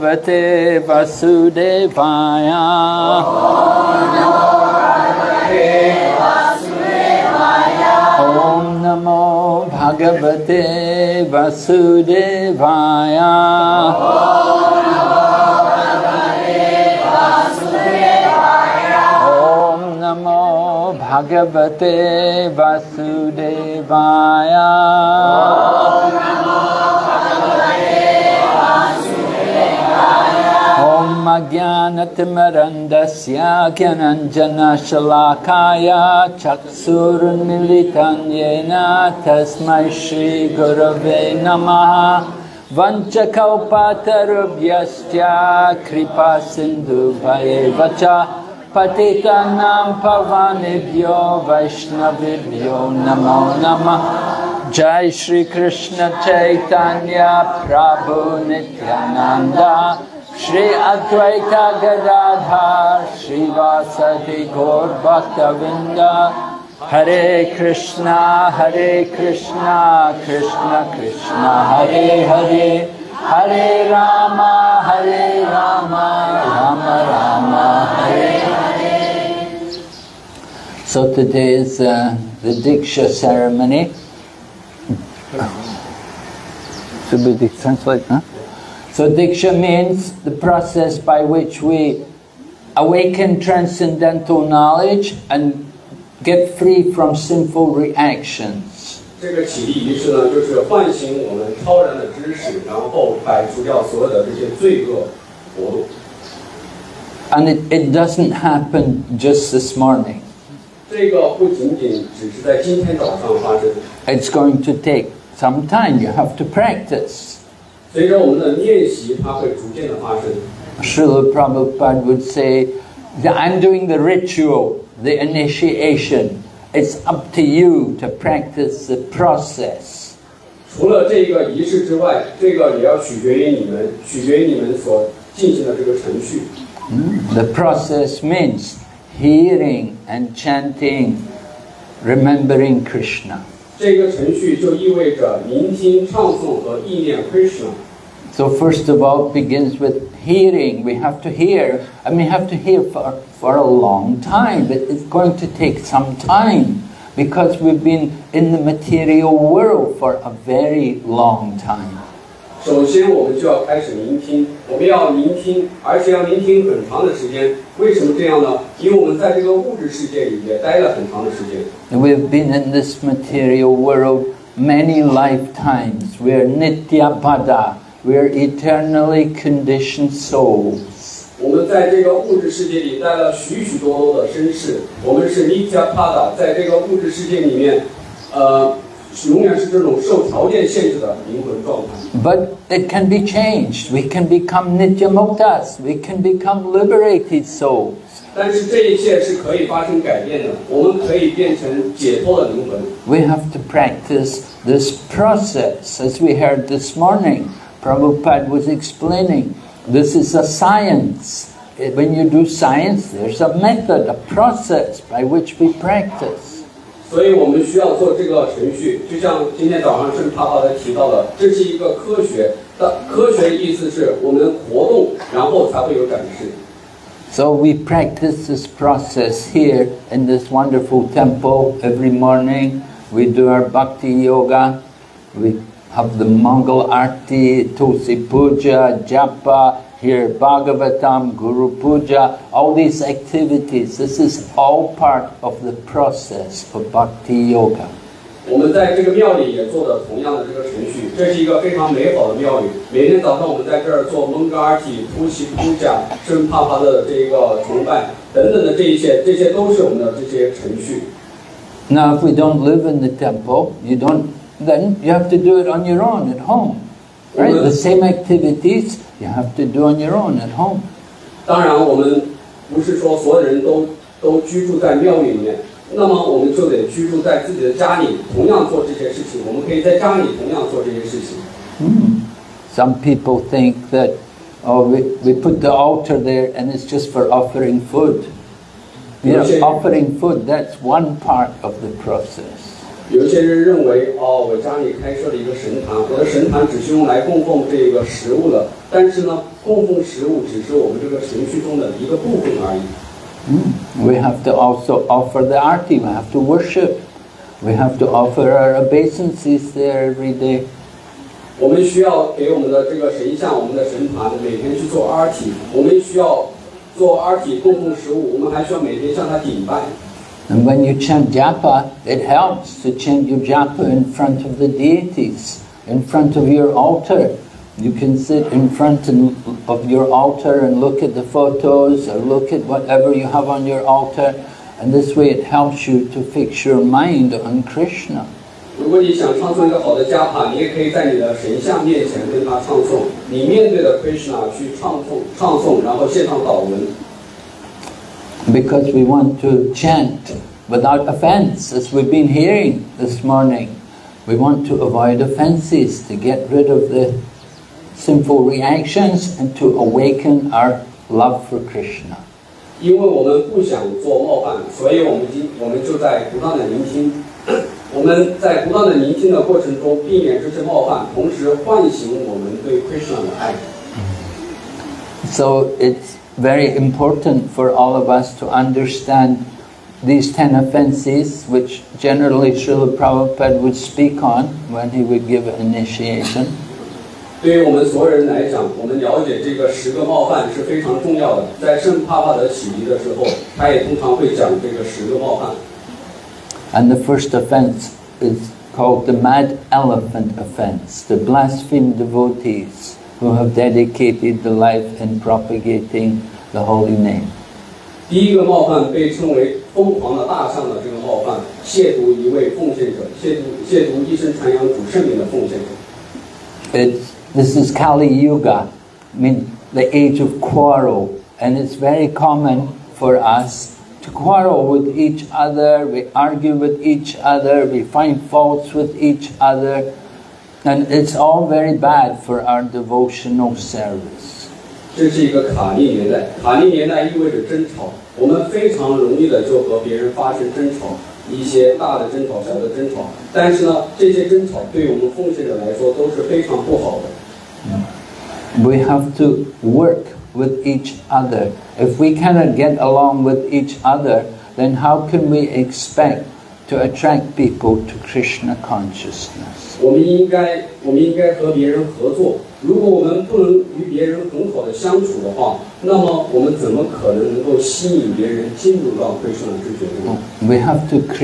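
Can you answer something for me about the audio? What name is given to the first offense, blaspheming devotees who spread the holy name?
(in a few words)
mad elephant offense.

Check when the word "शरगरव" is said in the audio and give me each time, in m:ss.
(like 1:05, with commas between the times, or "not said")
0:40.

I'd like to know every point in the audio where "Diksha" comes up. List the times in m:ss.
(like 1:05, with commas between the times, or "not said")
1:22, 1:29.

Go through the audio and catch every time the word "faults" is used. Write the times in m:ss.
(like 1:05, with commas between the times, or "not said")
7:08.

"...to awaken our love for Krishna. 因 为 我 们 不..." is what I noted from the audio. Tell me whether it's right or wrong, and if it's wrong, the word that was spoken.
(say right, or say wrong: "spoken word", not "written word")
right.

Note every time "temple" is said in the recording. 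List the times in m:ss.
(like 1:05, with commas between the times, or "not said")
3:51, 4:23.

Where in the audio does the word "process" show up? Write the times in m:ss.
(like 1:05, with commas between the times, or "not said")
1:30, 2:09, 2:17, 3:25, 3:34, 3:48, 4:05, 4:52.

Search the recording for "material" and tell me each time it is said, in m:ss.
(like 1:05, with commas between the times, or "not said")
2:38, 2:53.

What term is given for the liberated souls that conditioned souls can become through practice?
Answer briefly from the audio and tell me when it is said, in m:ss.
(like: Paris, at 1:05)
nityamuktas, at 3:14.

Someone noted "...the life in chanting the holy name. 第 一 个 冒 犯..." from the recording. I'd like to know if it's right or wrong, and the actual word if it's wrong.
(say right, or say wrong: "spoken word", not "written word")
wrong: "propagating", not "chanting".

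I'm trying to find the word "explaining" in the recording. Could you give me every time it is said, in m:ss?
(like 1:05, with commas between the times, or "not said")
3:28.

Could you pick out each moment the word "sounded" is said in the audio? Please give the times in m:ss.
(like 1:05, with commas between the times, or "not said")
not said.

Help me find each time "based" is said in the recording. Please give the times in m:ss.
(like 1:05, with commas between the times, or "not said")
not said.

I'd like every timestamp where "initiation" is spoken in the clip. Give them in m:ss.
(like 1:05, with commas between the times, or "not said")
2:05, 6:25.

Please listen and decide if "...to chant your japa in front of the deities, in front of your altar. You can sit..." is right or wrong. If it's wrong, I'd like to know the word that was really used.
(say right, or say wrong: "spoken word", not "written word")
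right.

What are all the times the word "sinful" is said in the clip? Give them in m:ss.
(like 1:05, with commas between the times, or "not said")
1:37, 5:57.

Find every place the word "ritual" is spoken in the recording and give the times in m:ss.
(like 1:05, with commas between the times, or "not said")
2:03.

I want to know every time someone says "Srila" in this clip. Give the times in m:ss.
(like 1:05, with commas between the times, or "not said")
2:00, 6:22.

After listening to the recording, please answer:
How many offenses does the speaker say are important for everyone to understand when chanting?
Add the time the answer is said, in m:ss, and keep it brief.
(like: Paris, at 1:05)
10, at 6:20.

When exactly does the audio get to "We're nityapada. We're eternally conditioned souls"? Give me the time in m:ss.
2:56.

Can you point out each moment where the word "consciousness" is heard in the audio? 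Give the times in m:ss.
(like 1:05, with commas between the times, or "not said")
7:38.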